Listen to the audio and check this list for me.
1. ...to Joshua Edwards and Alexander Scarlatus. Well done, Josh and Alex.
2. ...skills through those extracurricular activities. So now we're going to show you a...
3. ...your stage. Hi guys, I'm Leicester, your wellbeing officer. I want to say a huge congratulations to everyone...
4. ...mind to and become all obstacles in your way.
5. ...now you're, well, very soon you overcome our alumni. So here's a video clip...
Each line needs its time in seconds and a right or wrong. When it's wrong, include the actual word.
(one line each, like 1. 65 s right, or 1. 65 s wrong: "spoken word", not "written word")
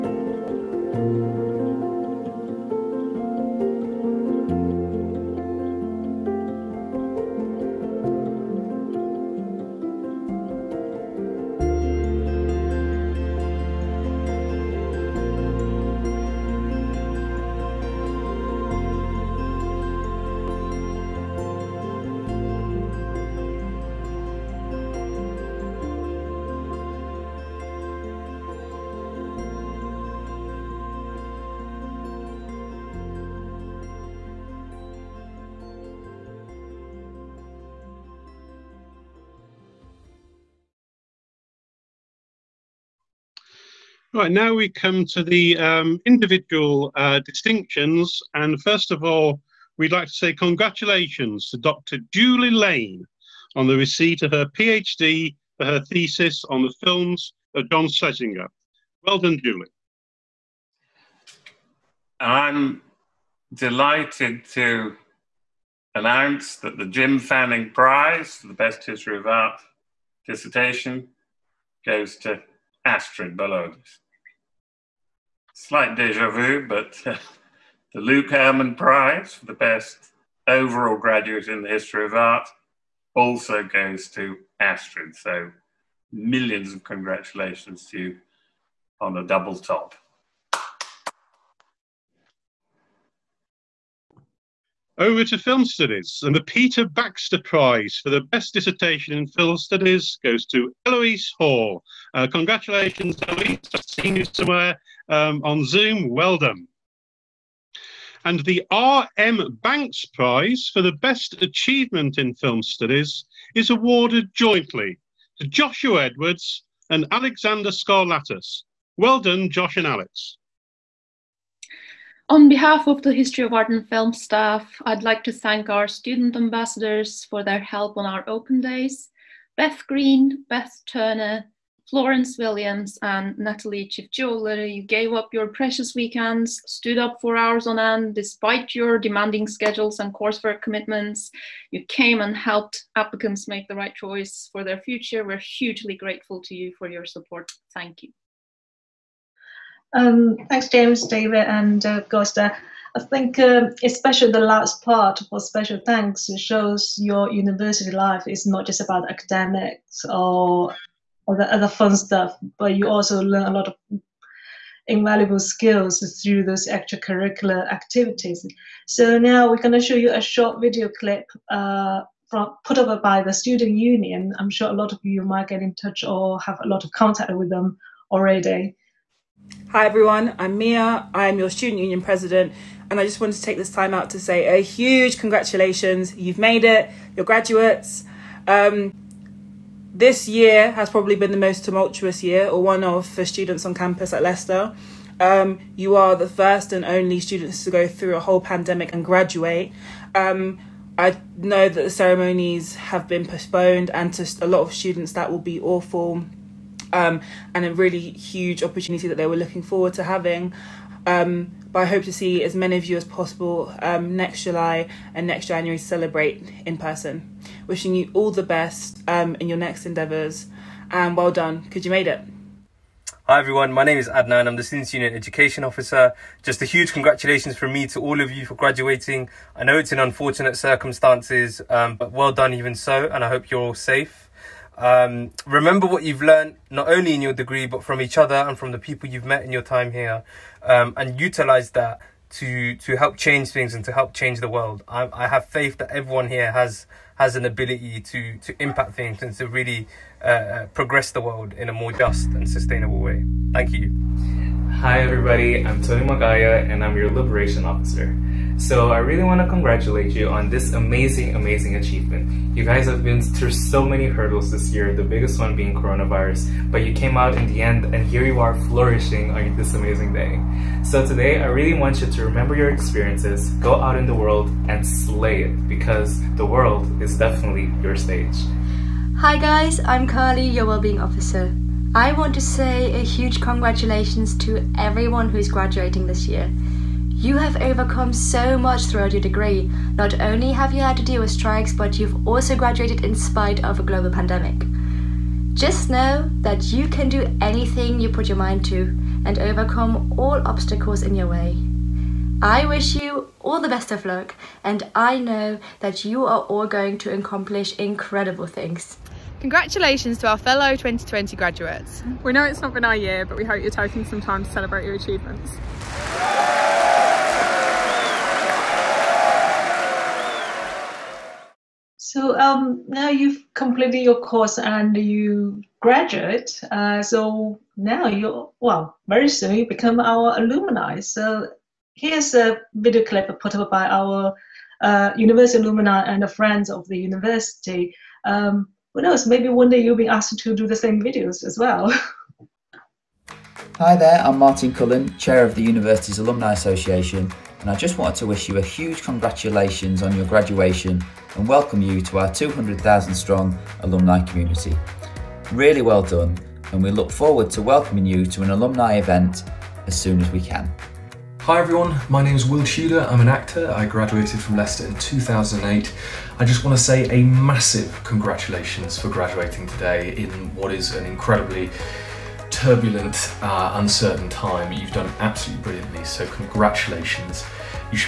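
1. 115 s right
2. 165 s right
3. 277 s wrong: "Carly", not "Leicester"
4. 298 s wrong: "overcome", not "become"
5. 327 s wrong: "become", not "overcome".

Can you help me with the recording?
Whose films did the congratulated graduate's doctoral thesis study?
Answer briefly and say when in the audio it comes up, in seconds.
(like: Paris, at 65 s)
John Schlesinger, at 57 s.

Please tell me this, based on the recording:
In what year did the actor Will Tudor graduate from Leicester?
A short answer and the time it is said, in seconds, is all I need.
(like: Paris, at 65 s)
2008, at 364 s.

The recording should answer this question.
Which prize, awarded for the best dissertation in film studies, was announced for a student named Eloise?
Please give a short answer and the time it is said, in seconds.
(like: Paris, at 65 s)
Peter Baxter Prize, at 96 s.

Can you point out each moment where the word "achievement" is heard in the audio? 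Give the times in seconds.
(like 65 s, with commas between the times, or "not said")
111 s, 261 s, 314 s.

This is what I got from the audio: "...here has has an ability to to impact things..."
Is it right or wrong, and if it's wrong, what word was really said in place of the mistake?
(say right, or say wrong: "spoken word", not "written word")
right.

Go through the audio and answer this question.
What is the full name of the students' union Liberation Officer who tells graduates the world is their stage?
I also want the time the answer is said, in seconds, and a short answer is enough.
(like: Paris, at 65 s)
Tony Magaya, at 255 s.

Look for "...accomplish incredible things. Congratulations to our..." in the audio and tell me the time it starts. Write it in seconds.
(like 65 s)
307 s.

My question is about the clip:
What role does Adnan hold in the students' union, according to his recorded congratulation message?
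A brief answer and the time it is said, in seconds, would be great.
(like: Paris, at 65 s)
Education Officer, at 225 s.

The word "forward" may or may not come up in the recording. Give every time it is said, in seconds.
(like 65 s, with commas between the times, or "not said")
209 s, 357 s.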